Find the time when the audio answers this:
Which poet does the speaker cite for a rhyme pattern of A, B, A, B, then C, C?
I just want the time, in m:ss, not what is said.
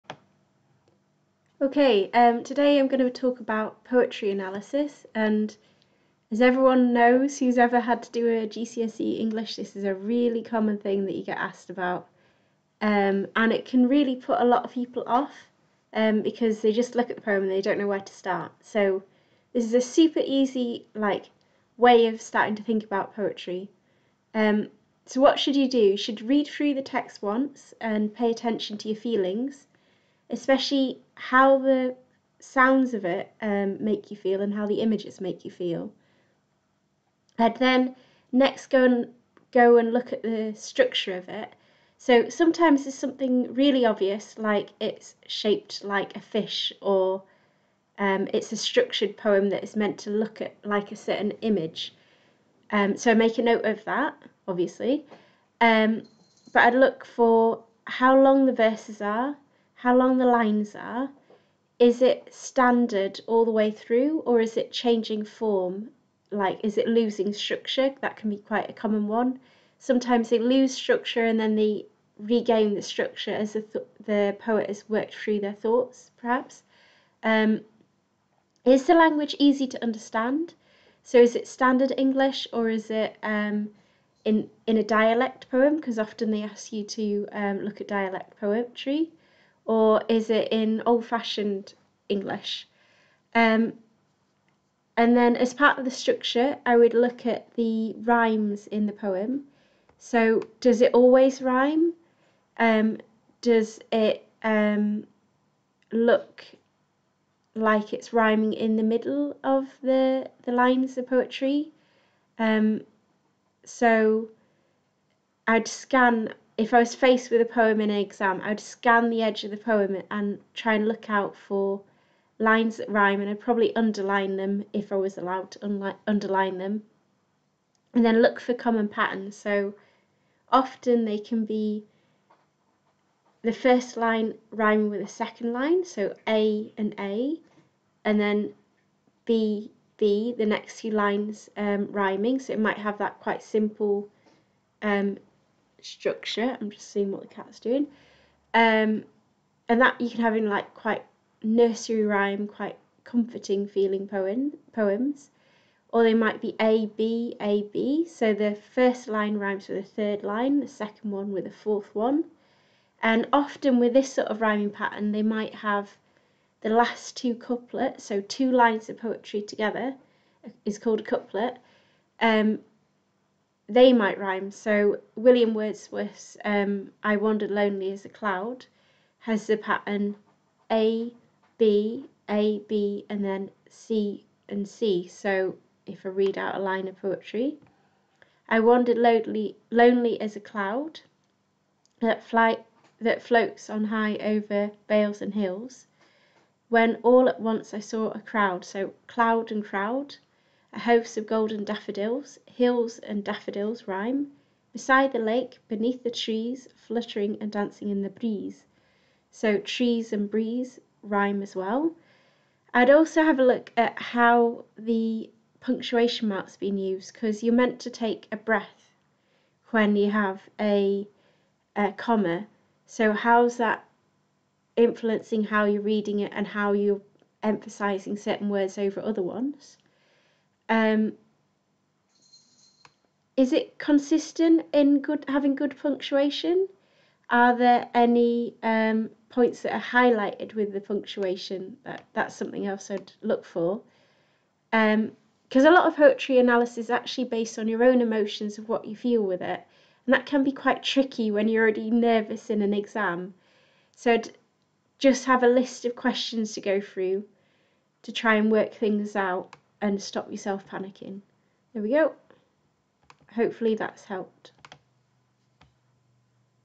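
2:55.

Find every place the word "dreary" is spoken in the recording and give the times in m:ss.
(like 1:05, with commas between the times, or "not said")
not said.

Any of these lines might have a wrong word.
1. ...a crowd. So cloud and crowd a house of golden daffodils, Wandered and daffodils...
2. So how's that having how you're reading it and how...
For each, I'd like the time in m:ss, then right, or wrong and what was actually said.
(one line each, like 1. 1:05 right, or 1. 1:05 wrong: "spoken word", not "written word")
1. 3:18 wrong: "Hills", not "Wandered"
2. 3:42 wrong: "influencing", not "having".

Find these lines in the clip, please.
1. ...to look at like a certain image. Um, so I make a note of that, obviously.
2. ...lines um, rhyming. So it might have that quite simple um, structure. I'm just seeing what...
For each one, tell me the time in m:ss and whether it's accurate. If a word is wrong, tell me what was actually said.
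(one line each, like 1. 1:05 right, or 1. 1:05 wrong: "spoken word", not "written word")
1. 0:49 right
2. 2:20 right.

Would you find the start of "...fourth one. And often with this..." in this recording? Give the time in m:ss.
2:41.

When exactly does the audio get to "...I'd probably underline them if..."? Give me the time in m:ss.
2:03.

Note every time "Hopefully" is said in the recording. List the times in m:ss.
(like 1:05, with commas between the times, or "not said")
4:23.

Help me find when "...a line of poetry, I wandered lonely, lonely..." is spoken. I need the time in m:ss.
3:06.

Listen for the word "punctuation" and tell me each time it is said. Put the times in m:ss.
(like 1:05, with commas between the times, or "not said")
3:35, 3:55, 4:00.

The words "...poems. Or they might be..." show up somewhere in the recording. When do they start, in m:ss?
2:34.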